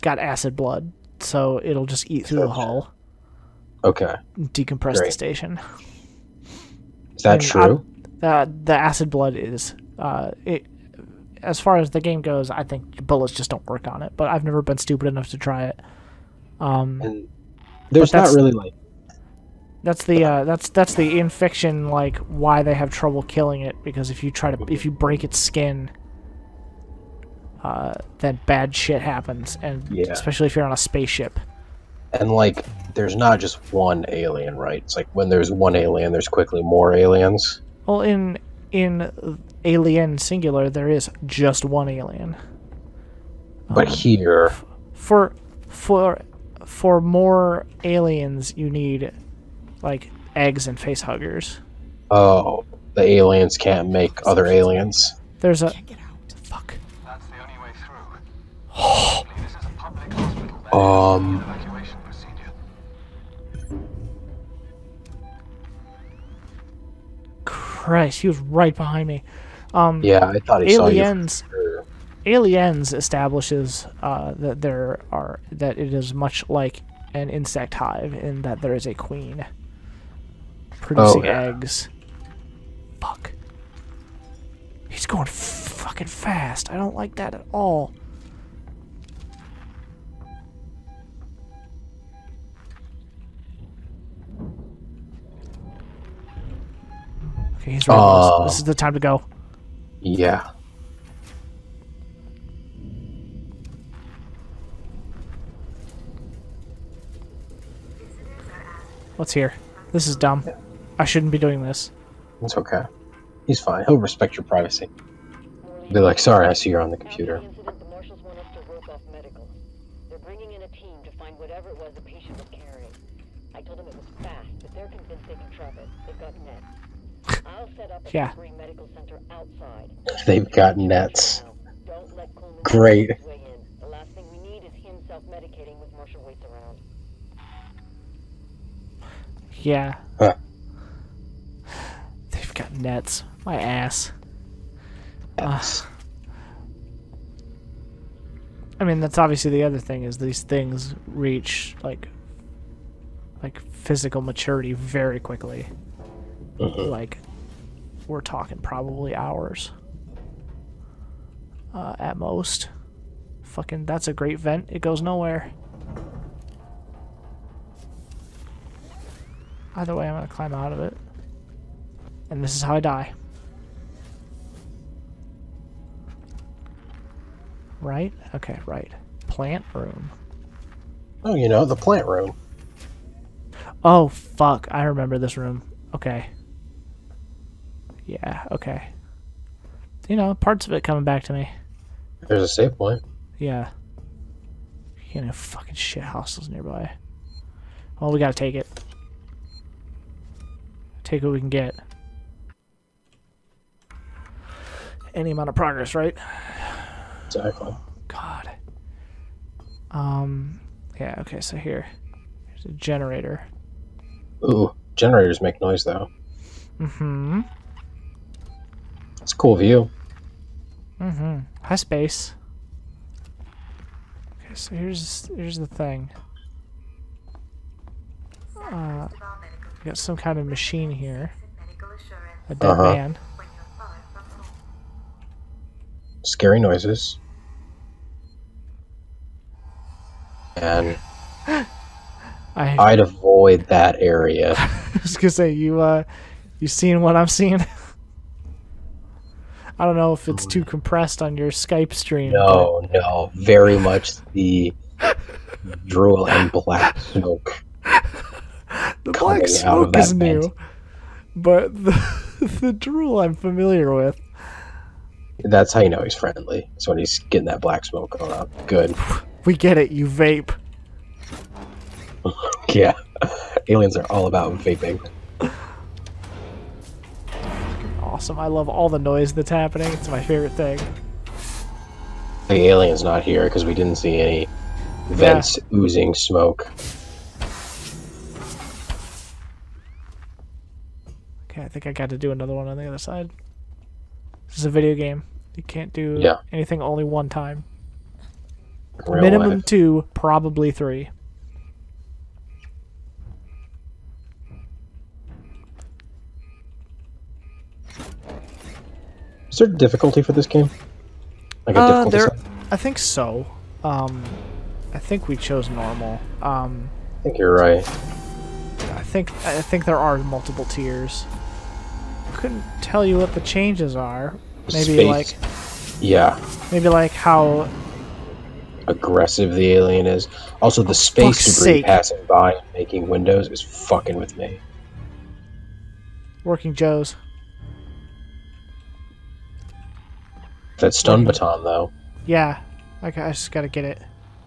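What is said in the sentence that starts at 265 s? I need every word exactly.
That's how you know he's friendly.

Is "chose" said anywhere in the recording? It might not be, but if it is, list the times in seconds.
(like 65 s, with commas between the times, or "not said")
315 s.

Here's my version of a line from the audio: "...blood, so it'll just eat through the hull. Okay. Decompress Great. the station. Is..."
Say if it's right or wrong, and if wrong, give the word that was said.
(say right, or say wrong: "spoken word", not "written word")
right.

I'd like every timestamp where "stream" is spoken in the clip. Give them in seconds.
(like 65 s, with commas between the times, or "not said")
251 s.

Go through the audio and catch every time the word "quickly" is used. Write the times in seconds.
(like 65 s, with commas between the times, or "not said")
36 s, 155 s.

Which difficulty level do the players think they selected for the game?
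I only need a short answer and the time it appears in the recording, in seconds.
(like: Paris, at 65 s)
Normal, at 315 s.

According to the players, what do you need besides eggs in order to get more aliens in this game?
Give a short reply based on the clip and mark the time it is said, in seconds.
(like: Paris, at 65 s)
Face huggers, at 50 s.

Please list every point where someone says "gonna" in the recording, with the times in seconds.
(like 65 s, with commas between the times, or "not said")
170 s, 245 s.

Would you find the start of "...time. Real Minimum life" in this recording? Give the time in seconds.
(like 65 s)
297 s.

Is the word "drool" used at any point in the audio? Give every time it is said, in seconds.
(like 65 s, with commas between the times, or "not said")
255 s, 262 s.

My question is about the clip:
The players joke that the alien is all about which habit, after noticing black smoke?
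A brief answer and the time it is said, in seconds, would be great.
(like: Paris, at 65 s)
Vaping, at 274 s.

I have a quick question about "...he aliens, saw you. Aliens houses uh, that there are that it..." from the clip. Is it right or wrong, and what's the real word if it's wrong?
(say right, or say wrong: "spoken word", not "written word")
wrong: "establishes", not "houses".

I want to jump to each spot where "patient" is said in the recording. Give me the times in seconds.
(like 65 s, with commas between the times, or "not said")
122 s.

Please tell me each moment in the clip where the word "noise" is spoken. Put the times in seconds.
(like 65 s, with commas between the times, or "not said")
215 s, 236 s, 278 s.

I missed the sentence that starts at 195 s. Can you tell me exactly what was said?
You know, fucking shit houses nearby.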